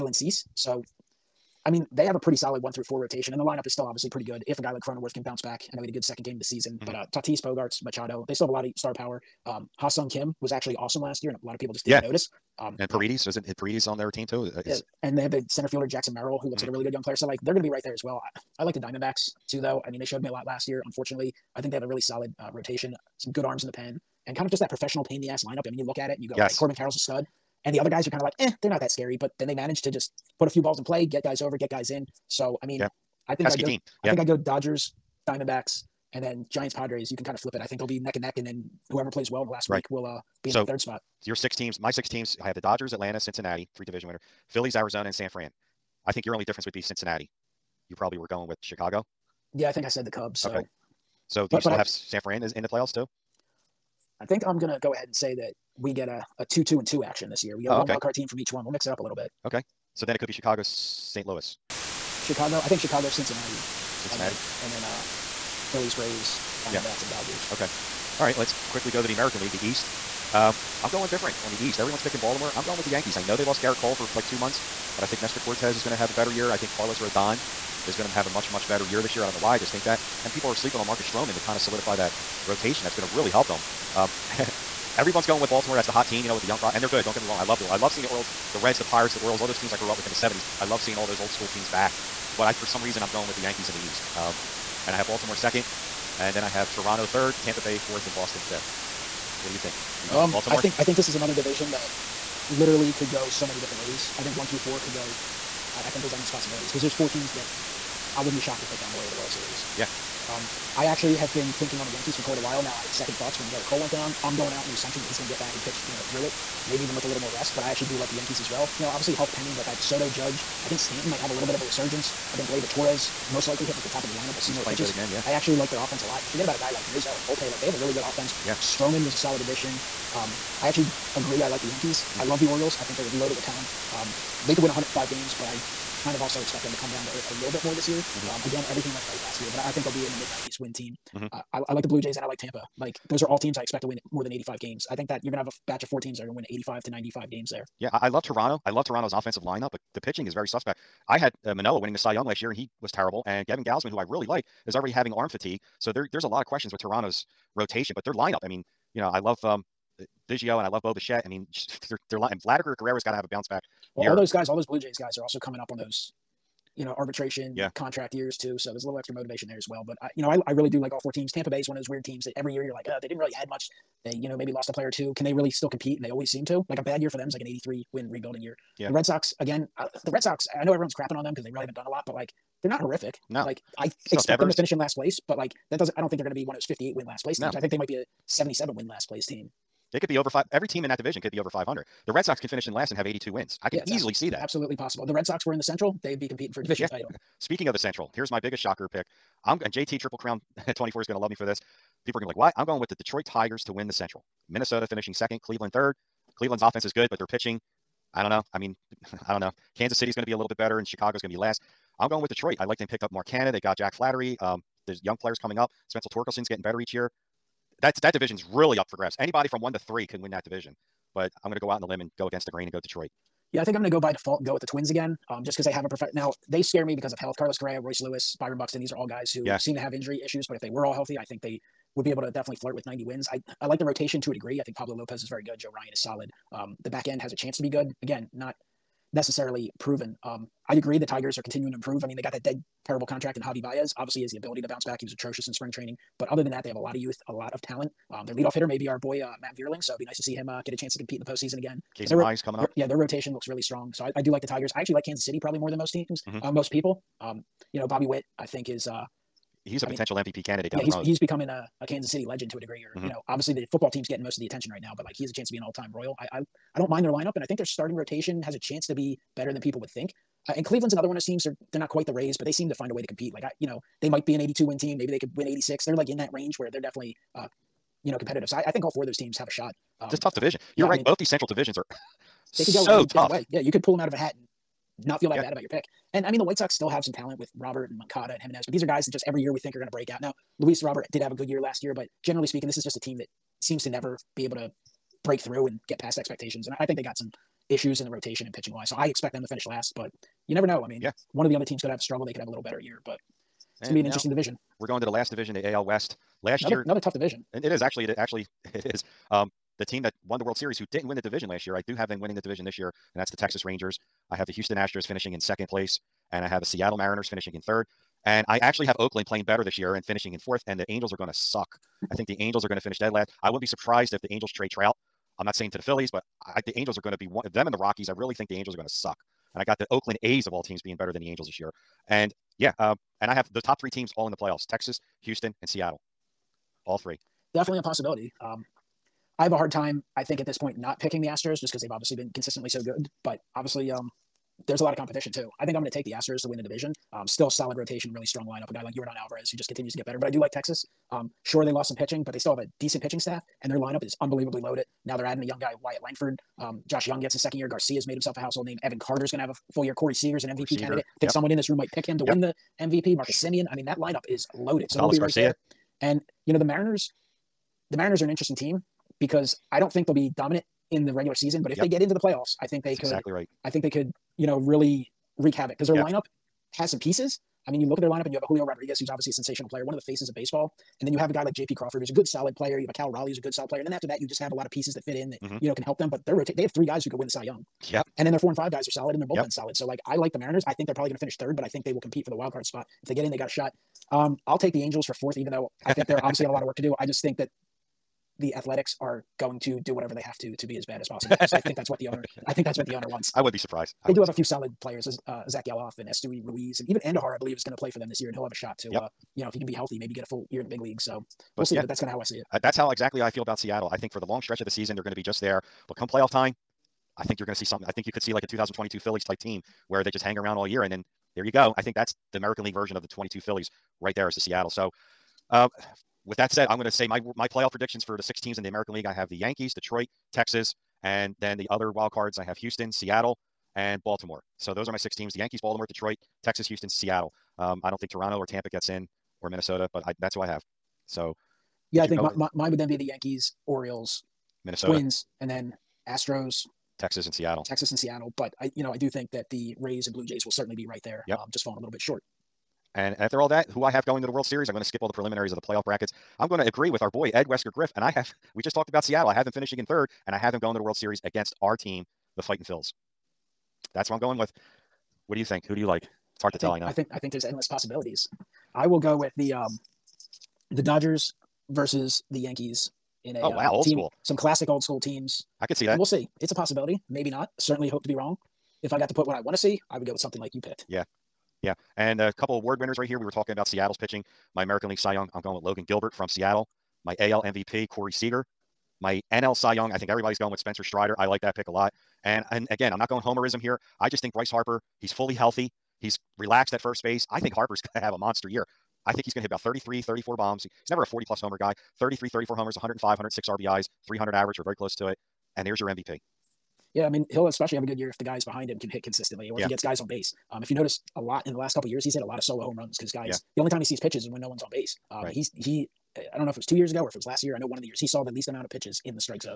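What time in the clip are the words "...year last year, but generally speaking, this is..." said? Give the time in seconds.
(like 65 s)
291 s.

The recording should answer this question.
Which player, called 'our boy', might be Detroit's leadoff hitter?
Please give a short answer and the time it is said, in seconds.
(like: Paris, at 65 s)
Matt Vierling, at 249 s.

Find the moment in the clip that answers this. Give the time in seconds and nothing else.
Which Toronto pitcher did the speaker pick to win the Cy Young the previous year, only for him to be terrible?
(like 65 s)
151 s.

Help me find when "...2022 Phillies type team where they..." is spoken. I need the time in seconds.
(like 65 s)
418 s.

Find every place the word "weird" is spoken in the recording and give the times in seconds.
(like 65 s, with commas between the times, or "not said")
171 s.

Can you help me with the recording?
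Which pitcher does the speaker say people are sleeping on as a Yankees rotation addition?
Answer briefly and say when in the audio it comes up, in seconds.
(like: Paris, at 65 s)
Marcus Stroman, at 80 s.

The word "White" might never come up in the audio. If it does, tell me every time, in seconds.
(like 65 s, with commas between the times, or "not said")
286 s.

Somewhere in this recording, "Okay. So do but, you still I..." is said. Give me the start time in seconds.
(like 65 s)
50 s.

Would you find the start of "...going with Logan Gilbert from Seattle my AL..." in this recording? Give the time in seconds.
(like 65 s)
485 s.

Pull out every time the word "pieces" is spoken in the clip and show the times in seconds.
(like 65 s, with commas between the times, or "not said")
376 s, 384 s.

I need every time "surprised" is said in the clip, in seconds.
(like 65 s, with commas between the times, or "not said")
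323 s, 403 s.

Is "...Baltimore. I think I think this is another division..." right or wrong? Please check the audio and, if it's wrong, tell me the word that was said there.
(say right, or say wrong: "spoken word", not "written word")
right.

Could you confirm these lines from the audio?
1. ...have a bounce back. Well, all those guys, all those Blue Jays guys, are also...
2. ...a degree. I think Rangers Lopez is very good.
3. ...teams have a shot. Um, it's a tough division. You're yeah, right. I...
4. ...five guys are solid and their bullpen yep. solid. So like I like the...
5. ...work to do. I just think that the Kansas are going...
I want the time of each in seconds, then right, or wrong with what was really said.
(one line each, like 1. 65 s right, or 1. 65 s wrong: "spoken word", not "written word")
1. 163 s right
2. 234 s wrong: "Pablo", not "Rangers"
3. 279 s right
4. 388 s right
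5. 396 s wrong: "Athletics", not "Kansas".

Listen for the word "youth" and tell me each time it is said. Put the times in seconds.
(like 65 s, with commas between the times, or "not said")
246 s.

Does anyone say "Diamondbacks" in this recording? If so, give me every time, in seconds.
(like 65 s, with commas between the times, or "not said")
18 s, 35 s, 66 s.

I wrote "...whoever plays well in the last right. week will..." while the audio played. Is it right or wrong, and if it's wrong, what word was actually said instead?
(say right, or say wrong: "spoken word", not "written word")
right.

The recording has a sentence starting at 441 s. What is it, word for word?
So yeah, I think my, my, mine would then be the Yankees, Orioles, Minnesota, Twins, and then Astros, Texas and Seattle.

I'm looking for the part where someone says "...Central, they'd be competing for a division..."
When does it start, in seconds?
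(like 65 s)
195 s.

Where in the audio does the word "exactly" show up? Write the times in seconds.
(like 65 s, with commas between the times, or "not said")
373 s, 412 s.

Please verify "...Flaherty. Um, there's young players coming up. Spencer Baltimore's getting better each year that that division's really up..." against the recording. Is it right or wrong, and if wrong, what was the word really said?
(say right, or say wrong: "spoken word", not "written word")
wrong: "Torkelson", not "Baltimore".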